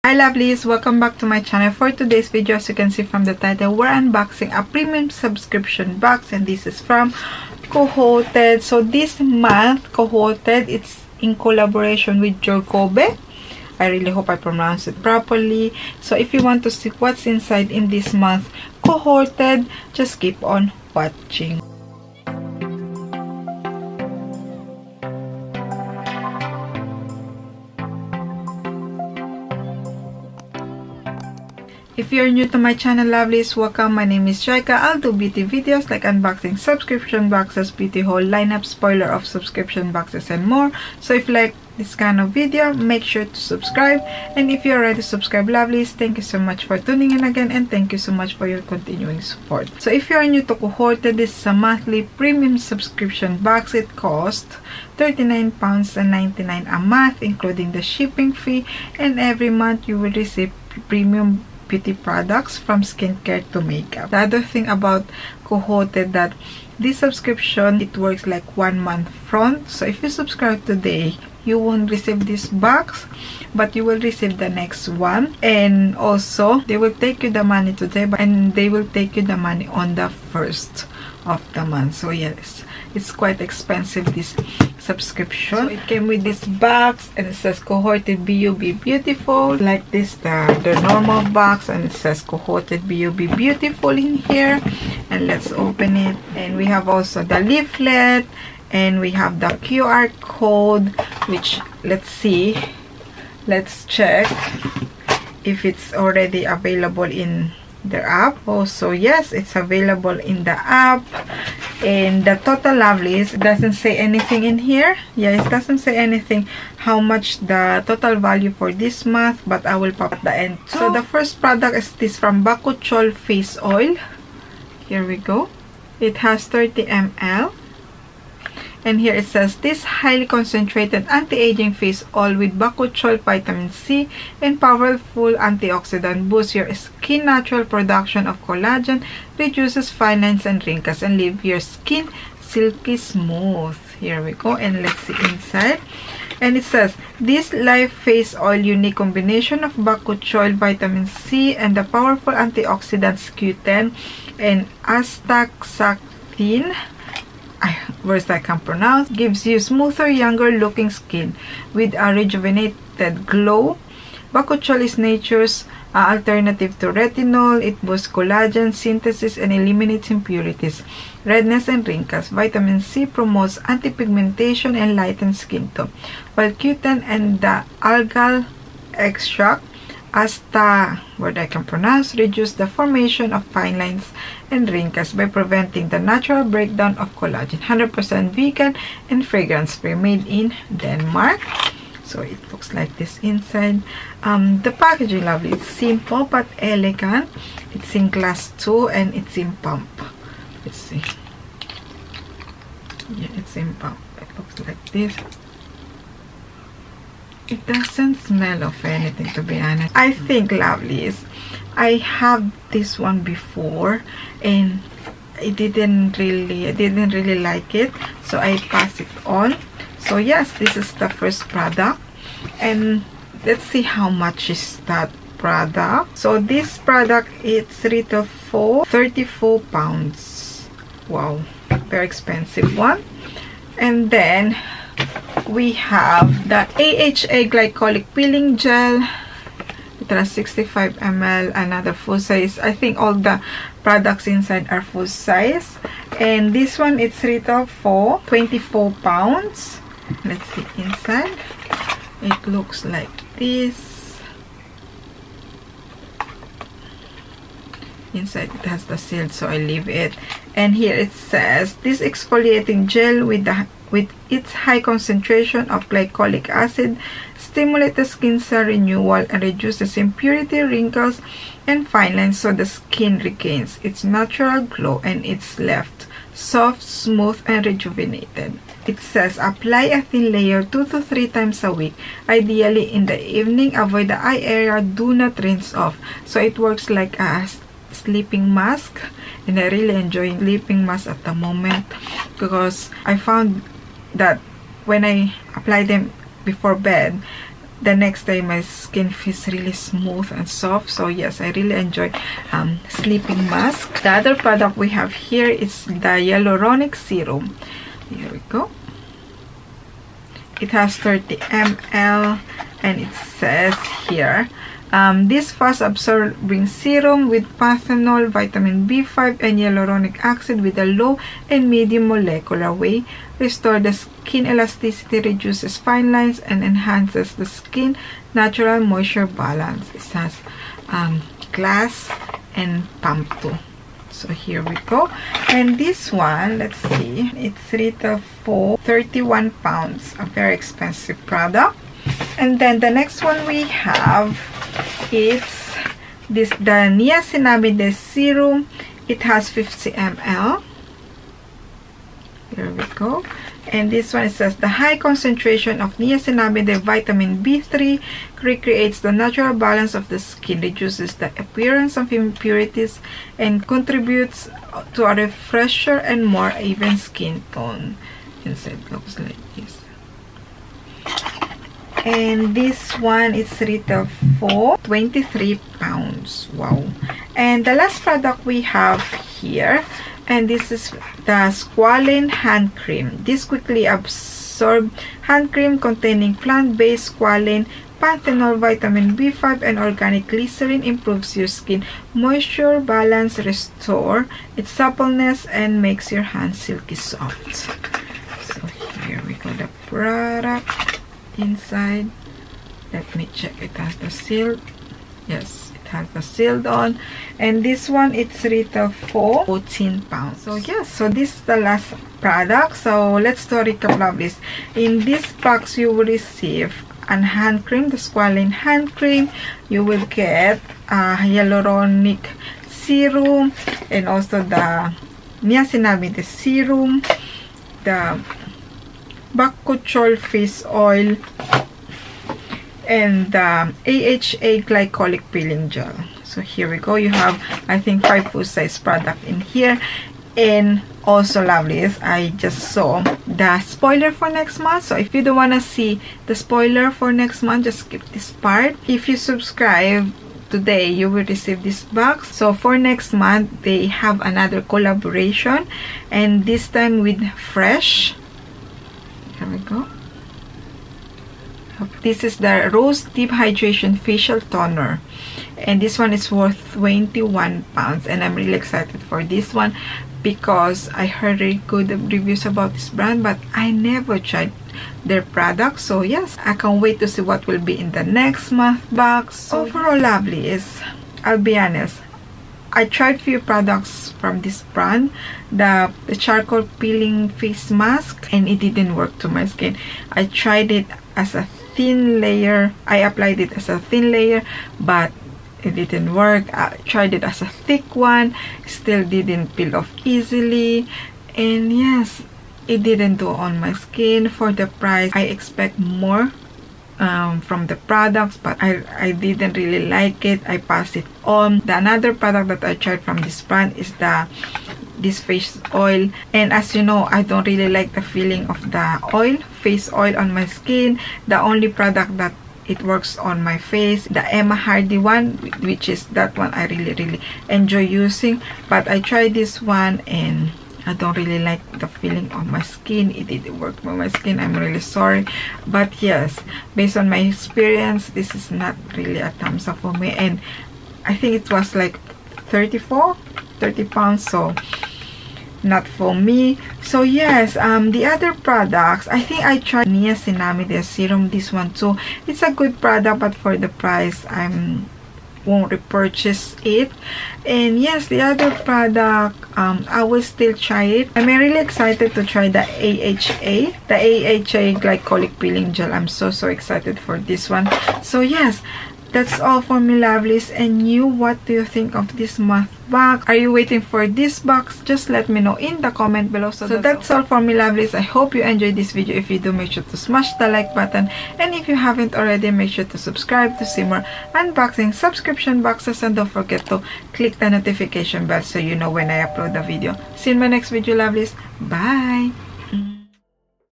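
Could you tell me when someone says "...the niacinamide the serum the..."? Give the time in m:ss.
7:04.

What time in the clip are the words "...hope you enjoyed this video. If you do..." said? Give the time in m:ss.
9:38.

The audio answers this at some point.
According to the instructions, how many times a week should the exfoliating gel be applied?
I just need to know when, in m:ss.
4:40.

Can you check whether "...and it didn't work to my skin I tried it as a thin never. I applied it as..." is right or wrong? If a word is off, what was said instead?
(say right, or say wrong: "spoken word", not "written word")
wrong: "layer", not "never".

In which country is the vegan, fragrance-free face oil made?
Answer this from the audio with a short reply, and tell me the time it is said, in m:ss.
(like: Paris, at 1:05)
Denmark, at 3:10.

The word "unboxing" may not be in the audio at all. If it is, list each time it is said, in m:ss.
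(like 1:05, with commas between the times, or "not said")
0:03, 0:36, 9:44.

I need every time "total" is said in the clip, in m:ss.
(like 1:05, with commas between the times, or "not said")
1:52, 1:57.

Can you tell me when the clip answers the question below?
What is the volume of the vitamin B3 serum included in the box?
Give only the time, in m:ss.
5:49.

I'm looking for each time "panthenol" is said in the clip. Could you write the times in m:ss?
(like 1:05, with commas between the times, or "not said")
5:17, 6:28.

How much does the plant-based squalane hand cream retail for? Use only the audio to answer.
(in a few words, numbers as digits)
14 pounds.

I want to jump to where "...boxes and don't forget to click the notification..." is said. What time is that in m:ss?
9:45.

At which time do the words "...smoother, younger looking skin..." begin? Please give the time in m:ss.
2:39.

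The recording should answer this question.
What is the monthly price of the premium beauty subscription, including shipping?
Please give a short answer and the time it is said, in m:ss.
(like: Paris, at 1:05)
£39.99, at 0:54.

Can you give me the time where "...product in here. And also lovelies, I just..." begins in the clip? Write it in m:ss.
7:18.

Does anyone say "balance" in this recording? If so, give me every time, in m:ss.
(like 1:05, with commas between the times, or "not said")
5:29, 5:59, 6:32.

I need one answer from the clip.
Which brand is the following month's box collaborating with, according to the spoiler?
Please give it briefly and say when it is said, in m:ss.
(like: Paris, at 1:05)
Fresh, at 7:37.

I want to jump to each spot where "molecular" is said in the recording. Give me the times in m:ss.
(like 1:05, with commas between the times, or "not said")
5:22.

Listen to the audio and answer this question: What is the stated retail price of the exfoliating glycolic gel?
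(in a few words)
24 pounds.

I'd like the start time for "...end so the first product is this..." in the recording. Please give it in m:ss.
2:00.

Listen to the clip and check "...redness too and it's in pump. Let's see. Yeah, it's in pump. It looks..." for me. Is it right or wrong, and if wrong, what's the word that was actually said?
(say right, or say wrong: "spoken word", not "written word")
wrong: "glass", not "redness".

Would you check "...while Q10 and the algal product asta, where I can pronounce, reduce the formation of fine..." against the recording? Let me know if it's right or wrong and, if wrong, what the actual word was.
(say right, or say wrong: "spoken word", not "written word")
wrong: "extract", not "product".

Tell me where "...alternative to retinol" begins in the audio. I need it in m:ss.
2:46.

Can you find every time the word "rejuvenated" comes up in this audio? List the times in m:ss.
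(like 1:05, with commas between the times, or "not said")
2:42, 4:37.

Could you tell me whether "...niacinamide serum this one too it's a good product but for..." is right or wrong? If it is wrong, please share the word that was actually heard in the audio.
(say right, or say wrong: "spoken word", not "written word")
right.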